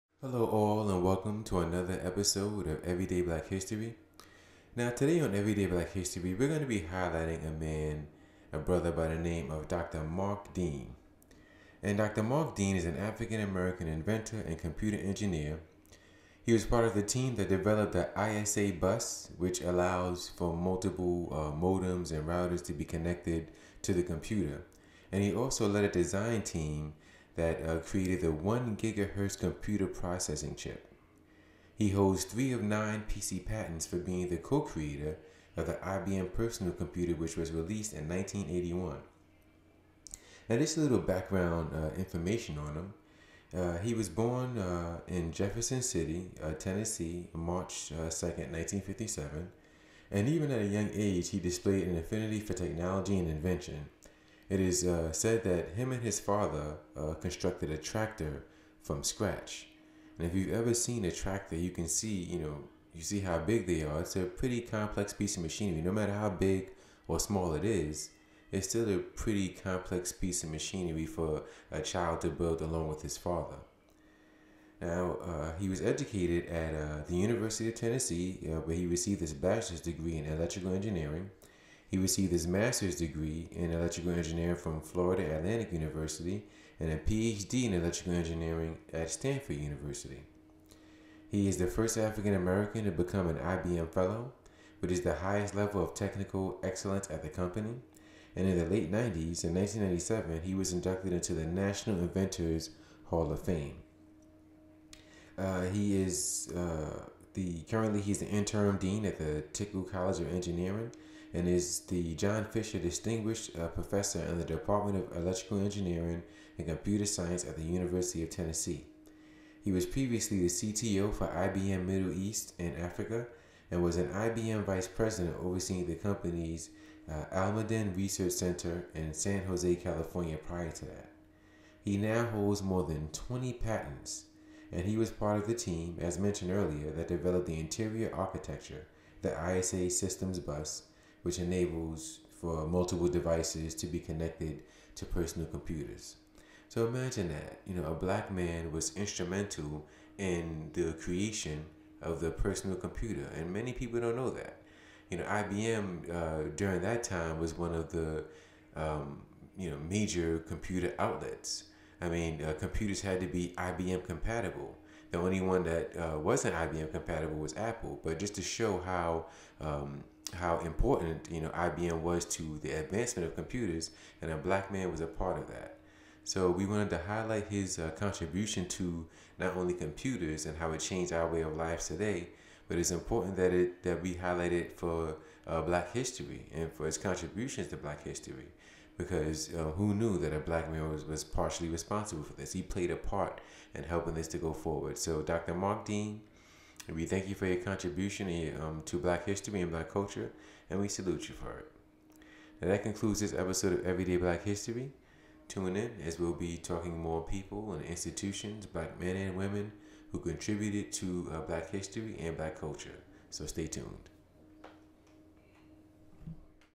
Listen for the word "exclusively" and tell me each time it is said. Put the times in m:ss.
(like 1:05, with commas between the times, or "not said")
not said.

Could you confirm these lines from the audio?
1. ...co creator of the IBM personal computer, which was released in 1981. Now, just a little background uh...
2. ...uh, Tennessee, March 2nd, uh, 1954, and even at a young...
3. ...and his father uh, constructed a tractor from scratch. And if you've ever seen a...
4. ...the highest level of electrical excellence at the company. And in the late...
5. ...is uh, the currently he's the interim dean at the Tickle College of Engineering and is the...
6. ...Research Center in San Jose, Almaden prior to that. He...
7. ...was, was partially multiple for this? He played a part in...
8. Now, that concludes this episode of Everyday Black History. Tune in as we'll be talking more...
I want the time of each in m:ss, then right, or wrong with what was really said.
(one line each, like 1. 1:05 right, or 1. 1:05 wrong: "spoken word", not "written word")
1. 0:34 right
2. 0:46 wrong: "1957", not "1954"
3. 0:55 right
4. 1:35 wrong: "technical", not "electrical"
5. 1:46 right
6. 2:07 wrong: "California", not "Almaden"
7. 3:10 wrong: "responsible", not "multiple"
8. 3:22 right.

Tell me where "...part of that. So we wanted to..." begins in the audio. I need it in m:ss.
2:55.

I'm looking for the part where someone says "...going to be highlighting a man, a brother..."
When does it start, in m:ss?
0:06.